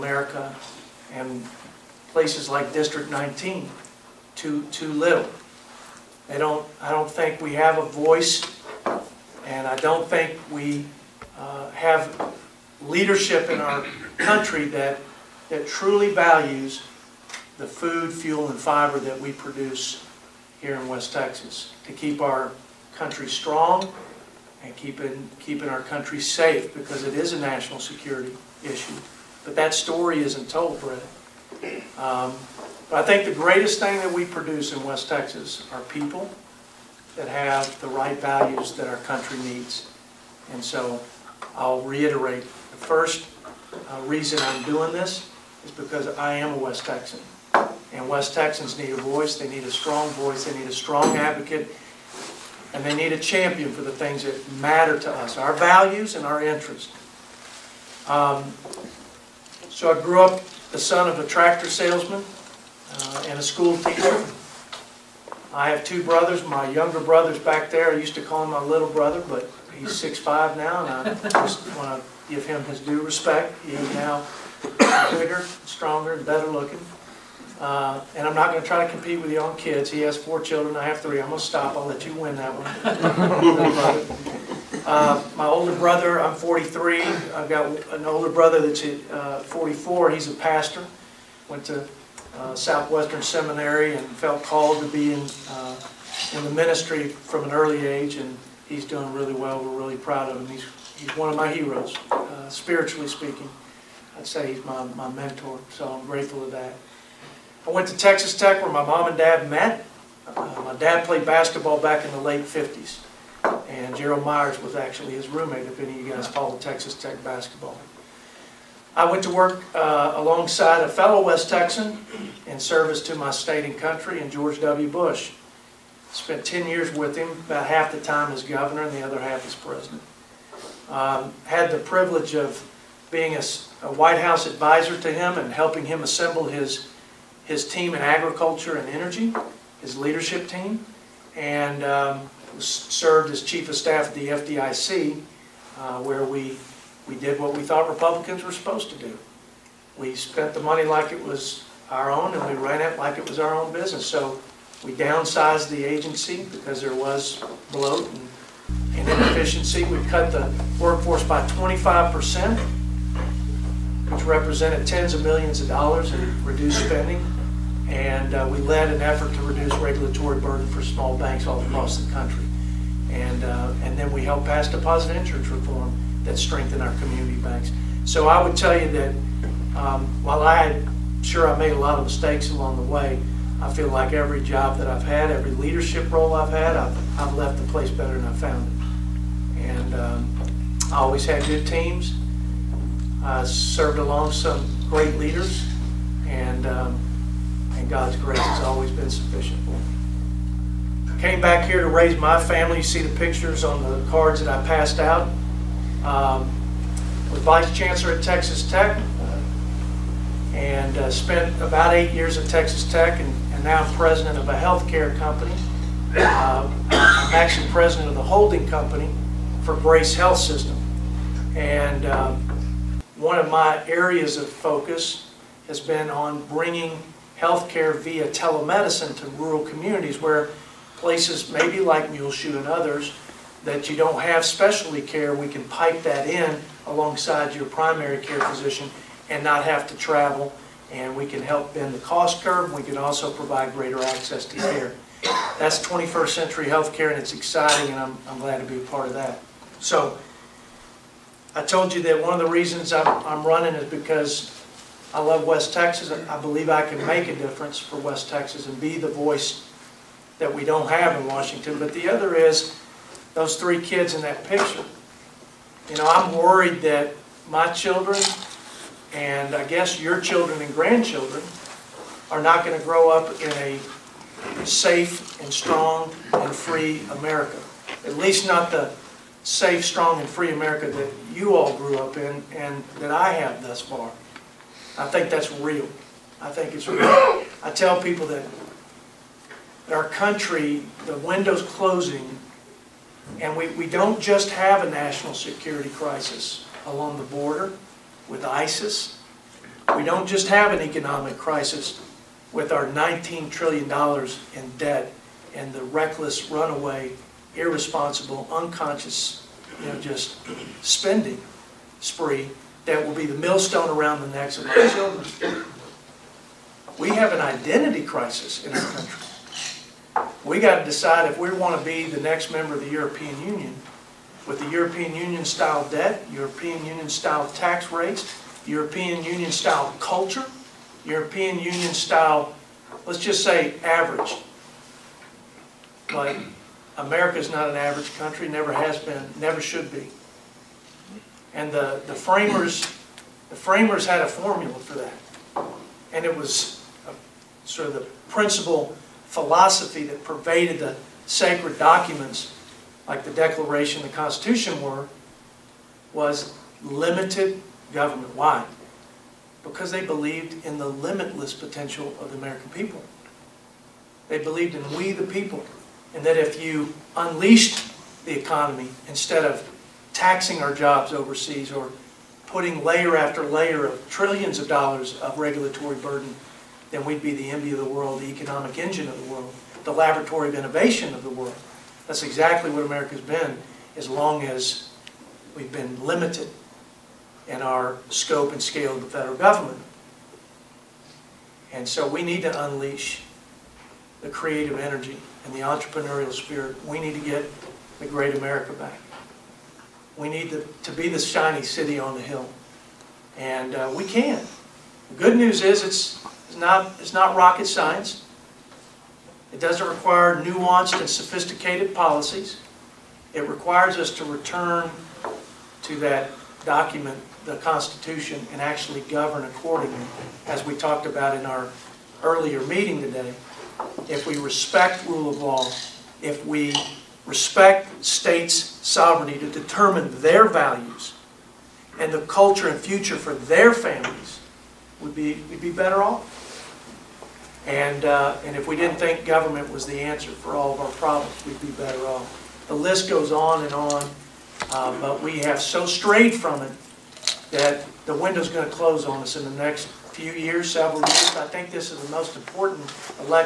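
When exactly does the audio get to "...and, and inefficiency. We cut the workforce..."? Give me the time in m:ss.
2:38.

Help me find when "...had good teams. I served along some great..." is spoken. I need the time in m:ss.
3:11.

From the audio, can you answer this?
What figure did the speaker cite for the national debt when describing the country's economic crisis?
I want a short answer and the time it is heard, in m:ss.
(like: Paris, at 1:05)
$19 trillion, at 5:02.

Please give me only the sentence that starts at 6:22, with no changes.
That's exactly what America's been as long as we've been limited in our scope and scale of the federal government.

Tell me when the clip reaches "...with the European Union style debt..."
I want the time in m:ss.
5:24.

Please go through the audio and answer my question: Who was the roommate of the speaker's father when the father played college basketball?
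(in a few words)
Gerald Myers.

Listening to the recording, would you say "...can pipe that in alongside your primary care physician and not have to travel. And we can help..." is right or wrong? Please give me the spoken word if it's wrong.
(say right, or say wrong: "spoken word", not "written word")
right.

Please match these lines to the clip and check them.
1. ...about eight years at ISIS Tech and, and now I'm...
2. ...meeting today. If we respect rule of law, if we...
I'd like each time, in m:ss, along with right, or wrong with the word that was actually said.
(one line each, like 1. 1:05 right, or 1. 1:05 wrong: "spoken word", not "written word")
1. 3:31 wrong: "Texas", not "ISIS"
2. 7:02 right.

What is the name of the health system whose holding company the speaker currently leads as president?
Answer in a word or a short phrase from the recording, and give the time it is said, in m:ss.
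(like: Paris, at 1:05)
Grace Health System, at 3:39.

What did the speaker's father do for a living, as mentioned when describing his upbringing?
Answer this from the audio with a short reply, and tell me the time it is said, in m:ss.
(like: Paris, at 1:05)
Tractor salesman, at 1:01.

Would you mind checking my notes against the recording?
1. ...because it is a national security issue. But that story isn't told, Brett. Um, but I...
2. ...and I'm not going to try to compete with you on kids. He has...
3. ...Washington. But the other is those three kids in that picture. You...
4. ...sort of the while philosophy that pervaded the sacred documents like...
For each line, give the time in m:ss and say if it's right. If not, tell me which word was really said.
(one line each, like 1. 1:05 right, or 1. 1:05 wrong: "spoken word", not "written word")
1. 0:26 right
2. 1:18 right
3. 4:21 right
4. 5:47 wrong: "principle", not "while".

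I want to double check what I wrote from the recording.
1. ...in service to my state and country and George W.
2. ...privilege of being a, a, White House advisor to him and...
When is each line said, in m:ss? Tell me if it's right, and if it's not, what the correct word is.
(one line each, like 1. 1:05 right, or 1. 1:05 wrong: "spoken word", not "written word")
1. 2:02 right
2. 2:11 right.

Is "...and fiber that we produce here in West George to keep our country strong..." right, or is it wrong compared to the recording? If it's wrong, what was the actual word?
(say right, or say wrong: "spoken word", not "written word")
wrong: "Texas", not "George".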